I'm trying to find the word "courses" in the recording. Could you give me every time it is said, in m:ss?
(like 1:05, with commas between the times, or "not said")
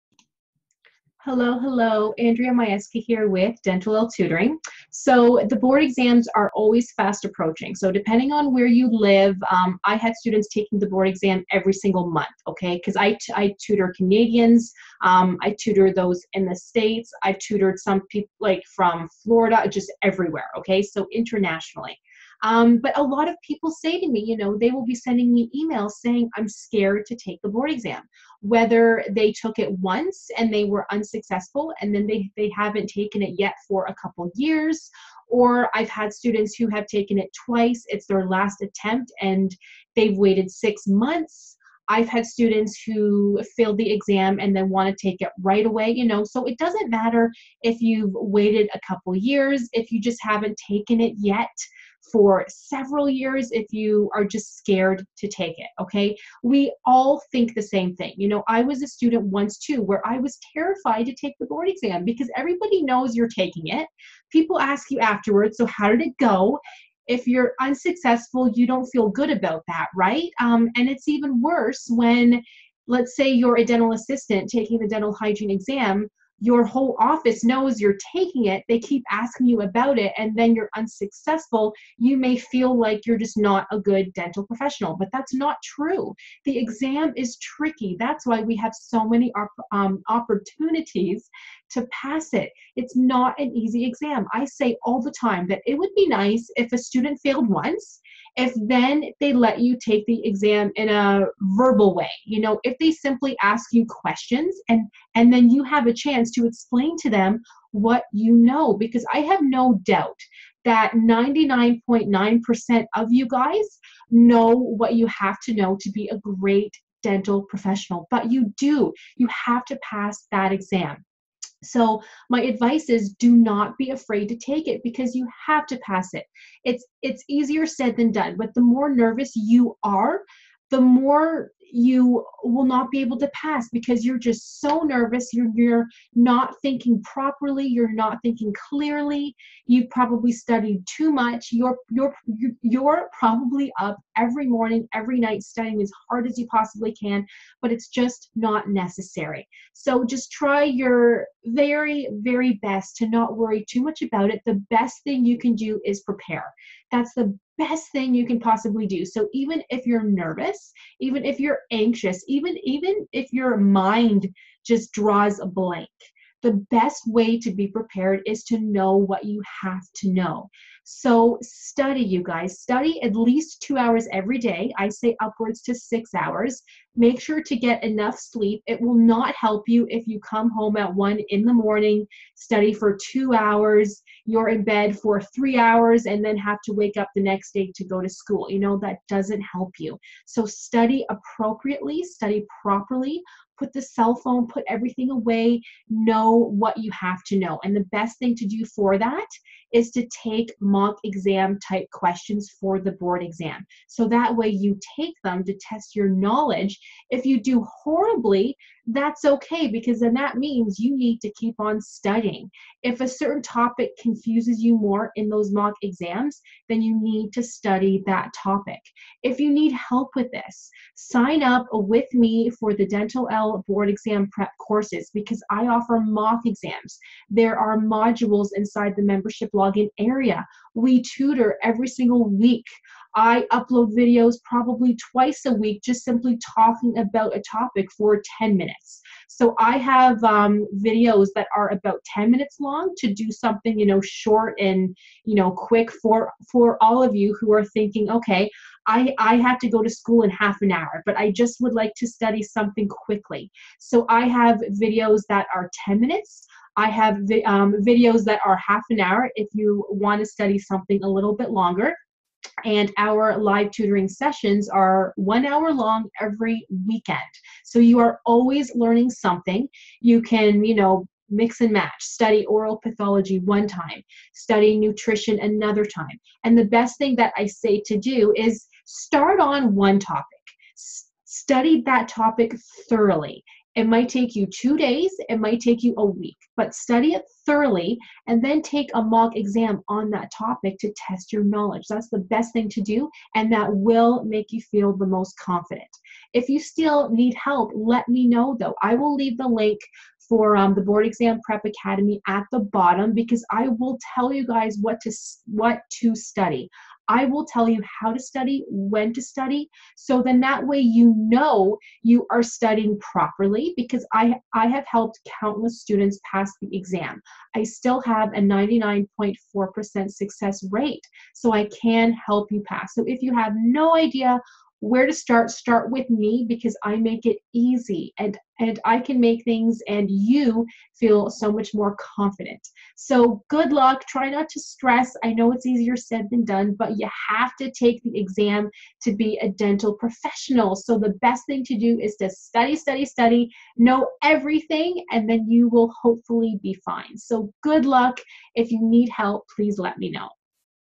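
3:44.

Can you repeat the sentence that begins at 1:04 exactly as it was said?
People ask you afterwards, so how did it go?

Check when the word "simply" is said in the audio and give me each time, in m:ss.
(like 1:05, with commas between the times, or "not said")
1:42, 3:56.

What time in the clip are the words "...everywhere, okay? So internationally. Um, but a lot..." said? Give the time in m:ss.
0:20.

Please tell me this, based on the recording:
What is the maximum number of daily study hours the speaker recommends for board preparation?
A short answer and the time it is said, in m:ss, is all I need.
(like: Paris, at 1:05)
6 hours, at 2:55.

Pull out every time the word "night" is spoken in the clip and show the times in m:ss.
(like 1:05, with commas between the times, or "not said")
2:25.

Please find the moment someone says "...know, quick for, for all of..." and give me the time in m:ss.
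4:05.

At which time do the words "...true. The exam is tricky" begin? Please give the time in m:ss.
1:25.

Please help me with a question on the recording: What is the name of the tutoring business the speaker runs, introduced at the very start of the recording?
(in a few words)
Dentalelle Tutoring.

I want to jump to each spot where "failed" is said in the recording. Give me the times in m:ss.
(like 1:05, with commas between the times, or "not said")
0:43, 1:37.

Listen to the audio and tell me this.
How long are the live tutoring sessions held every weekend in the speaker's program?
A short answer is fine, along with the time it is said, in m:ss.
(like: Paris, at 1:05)
1 hour, at 4:25.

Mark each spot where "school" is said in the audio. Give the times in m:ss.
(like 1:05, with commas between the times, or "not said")
3:08, 4:09.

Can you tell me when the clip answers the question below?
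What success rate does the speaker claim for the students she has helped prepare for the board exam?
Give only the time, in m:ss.
5:18.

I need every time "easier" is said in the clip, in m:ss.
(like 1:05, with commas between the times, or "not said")
2:07, 5:35.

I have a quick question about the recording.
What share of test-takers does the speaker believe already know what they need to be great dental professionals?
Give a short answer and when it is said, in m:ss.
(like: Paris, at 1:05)
99.9%, at 1:50.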